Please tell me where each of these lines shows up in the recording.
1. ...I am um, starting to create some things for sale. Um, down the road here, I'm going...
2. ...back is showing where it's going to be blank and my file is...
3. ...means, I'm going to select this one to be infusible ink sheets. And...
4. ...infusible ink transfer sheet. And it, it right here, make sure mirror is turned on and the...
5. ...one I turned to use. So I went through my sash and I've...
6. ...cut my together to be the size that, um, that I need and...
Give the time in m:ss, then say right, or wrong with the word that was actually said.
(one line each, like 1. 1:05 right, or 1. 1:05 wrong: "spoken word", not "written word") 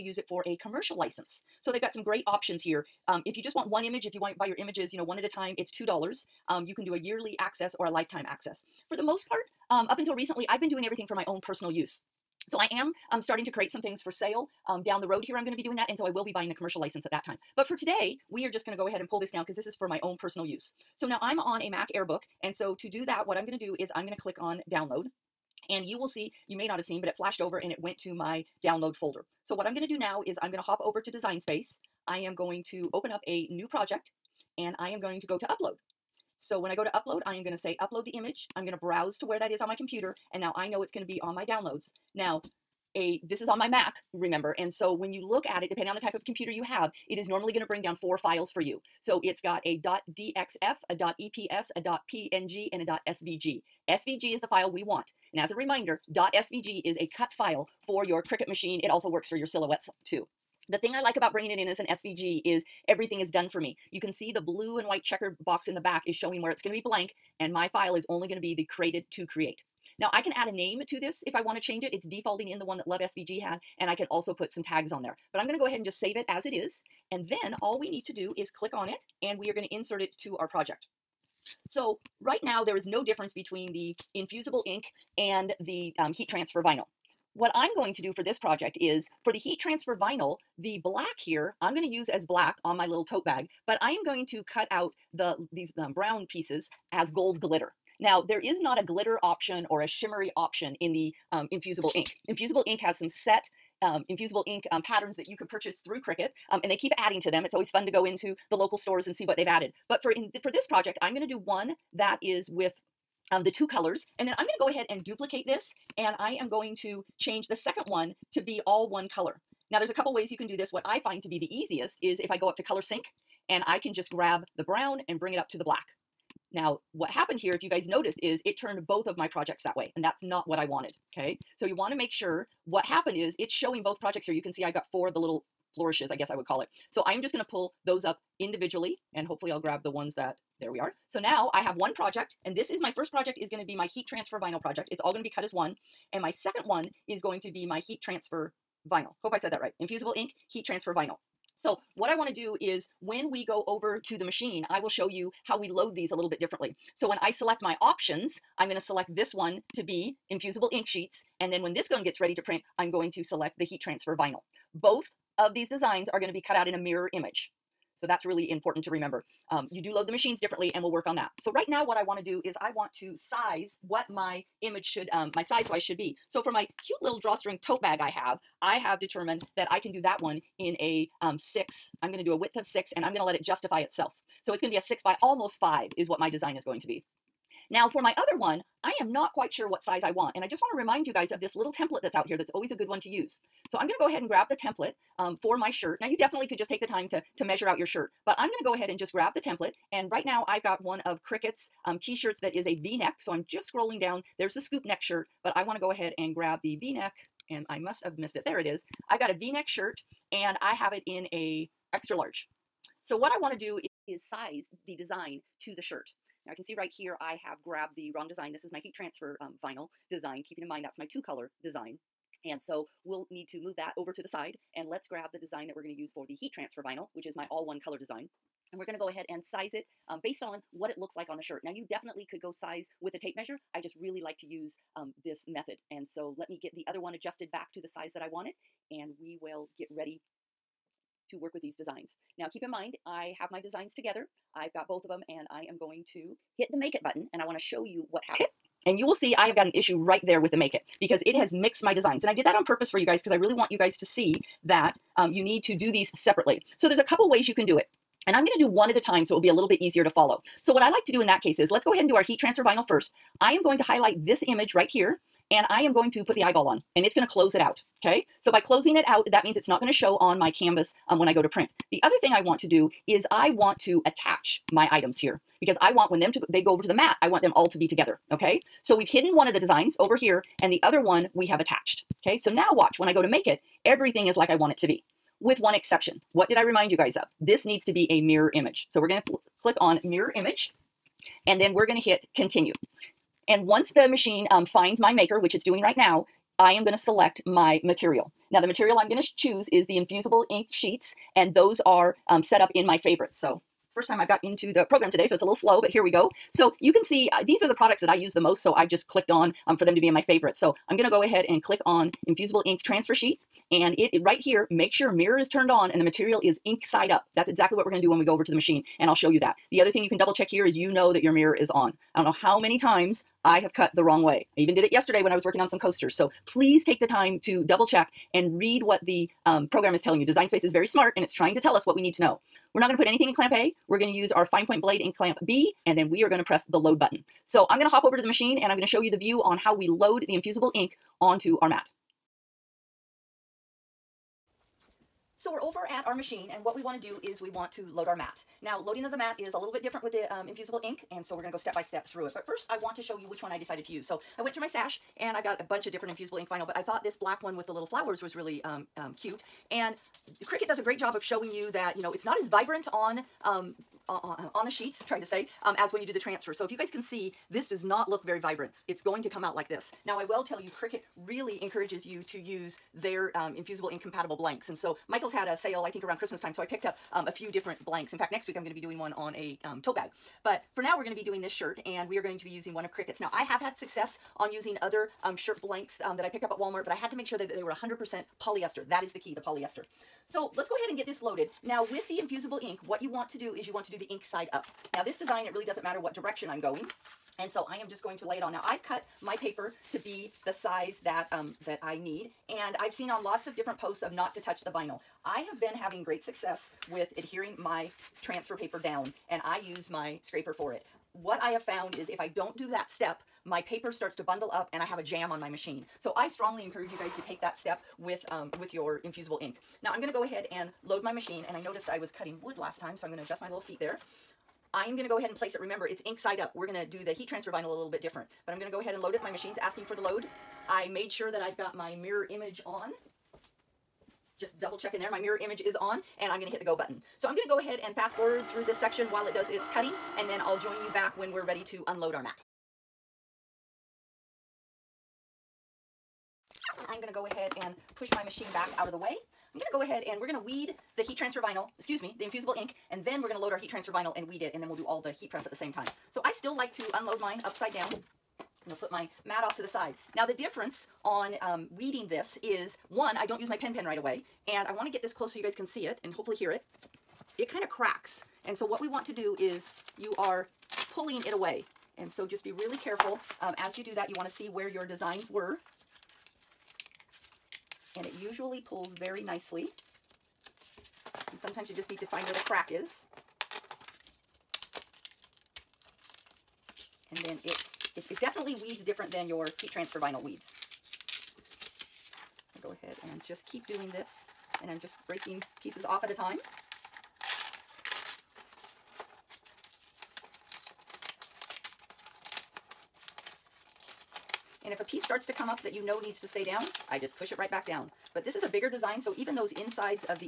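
1. 0:12 right
2. 1:05 right
3. 2:37 wrong: "options", not "means"
4. 5:12 right
5. 5:53 wrong: "decided", not "turned"
6. 6:38 wrong: "paper", not "together".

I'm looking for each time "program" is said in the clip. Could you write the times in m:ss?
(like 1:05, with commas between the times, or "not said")
5:04, 5:29.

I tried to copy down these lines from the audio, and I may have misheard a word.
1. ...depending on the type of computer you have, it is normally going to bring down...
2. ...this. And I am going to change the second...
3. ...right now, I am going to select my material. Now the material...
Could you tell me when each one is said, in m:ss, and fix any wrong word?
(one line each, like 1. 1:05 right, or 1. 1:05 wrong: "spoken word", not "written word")
1. 0:45 right
2. 1:55 right
3. 4:55 right.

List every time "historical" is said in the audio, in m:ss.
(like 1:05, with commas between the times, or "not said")
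not said.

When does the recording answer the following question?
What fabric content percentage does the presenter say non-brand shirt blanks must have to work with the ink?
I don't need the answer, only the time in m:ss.
6:27.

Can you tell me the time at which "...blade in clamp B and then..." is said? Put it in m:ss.
5:34.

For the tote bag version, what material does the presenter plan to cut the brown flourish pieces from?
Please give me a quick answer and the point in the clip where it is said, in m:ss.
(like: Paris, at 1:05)
gold glitter, at 1:37.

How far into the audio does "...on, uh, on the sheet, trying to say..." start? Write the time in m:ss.
6:04.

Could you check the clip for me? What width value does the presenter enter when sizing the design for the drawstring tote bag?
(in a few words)
6.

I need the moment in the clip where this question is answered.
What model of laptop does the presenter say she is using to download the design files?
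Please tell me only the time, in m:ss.
0:21.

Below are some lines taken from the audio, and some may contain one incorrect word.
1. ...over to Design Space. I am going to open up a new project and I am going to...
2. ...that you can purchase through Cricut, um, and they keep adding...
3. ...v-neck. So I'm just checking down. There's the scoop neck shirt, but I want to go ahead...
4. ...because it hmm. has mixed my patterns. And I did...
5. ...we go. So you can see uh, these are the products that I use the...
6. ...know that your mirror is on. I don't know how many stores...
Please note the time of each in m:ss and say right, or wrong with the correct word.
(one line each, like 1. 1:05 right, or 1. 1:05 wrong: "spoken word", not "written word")
1. 0:30 right
2. 1:45 right
3. 3:22 wrong: "scrolling", not "checking"
4. 4:11 wrong: "designs", not "patterns"
5. 5:06 right
6. 5:20 wrong: "times", not "stores".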